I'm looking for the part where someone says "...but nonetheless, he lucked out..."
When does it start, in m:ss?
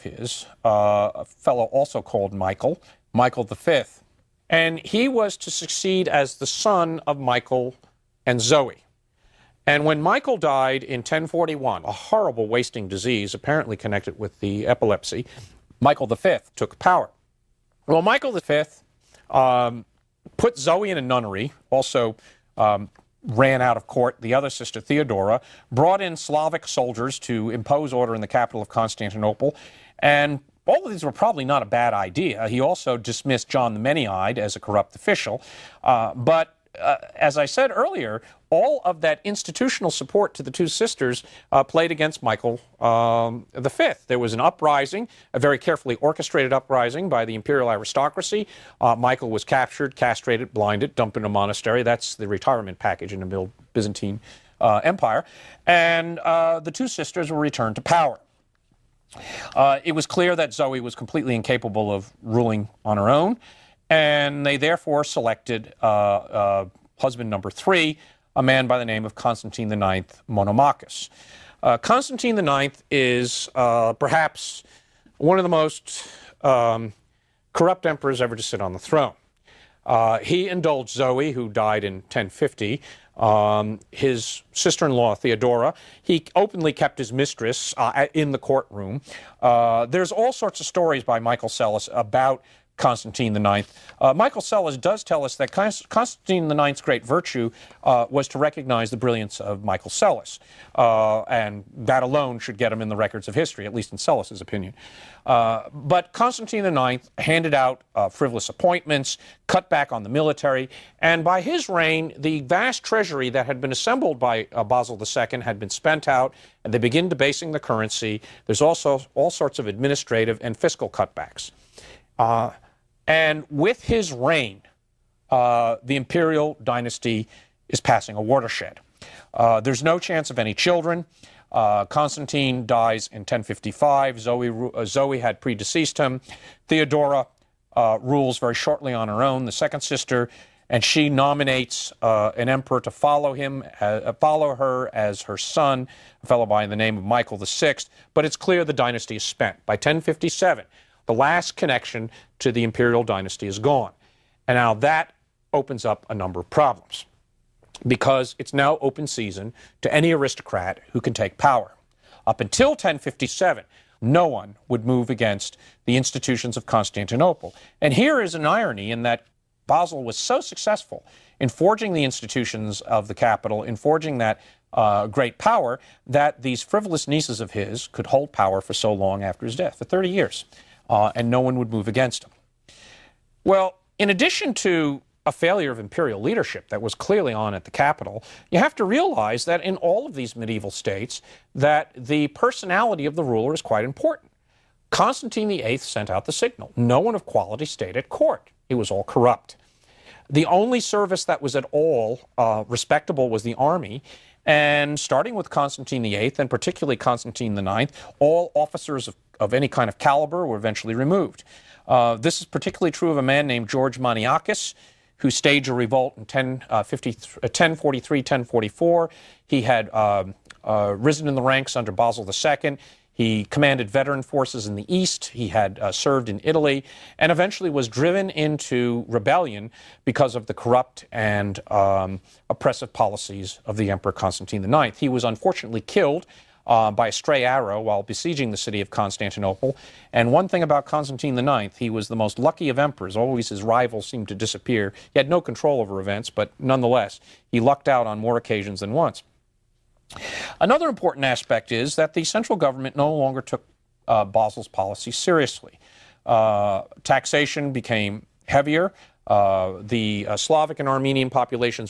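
4:06.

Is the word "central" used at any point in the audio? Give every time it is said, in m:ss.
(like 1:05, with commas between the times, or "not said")
4:12.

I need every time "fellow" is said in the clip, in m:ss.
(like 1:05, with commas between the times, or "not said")
0:01, 2:26.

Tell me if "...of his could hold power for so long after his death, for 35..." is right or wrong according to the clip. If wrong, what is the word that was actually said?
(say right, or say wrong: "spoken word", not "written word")
wrong: "30", not "35".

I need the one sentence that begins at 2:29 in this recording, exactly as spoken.
By 1057, the last connection to the imperial dynasty is gone.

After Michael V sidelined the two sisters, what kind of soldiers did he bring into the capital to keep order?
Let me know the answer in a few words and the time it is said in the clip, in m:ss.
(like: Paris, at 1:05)
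Slavic soldiers, at 0:26.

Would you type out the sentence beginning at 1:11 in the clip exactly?
Uh, Constantine IX is uh, perhaps one of the most um, corrupt emperors ever to sit on the throne.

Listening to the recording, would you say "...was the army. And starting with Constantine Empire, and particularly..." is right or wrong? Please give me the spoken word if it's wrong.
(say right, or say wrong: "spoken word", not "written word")
wrong: "VIII", not "Empire".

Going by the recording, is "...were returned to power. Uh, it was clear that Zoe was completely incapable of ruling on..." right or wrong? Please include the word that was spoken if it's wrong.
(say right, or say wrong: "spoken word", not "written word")
right.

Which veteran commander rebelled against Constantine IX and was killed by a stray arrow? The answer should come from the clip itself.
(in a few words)
George Maniakis.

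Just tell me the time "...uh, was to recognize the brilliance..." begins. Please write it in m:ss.
1:37.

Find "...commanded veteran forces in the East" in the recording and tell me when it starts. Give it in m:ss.
3:43.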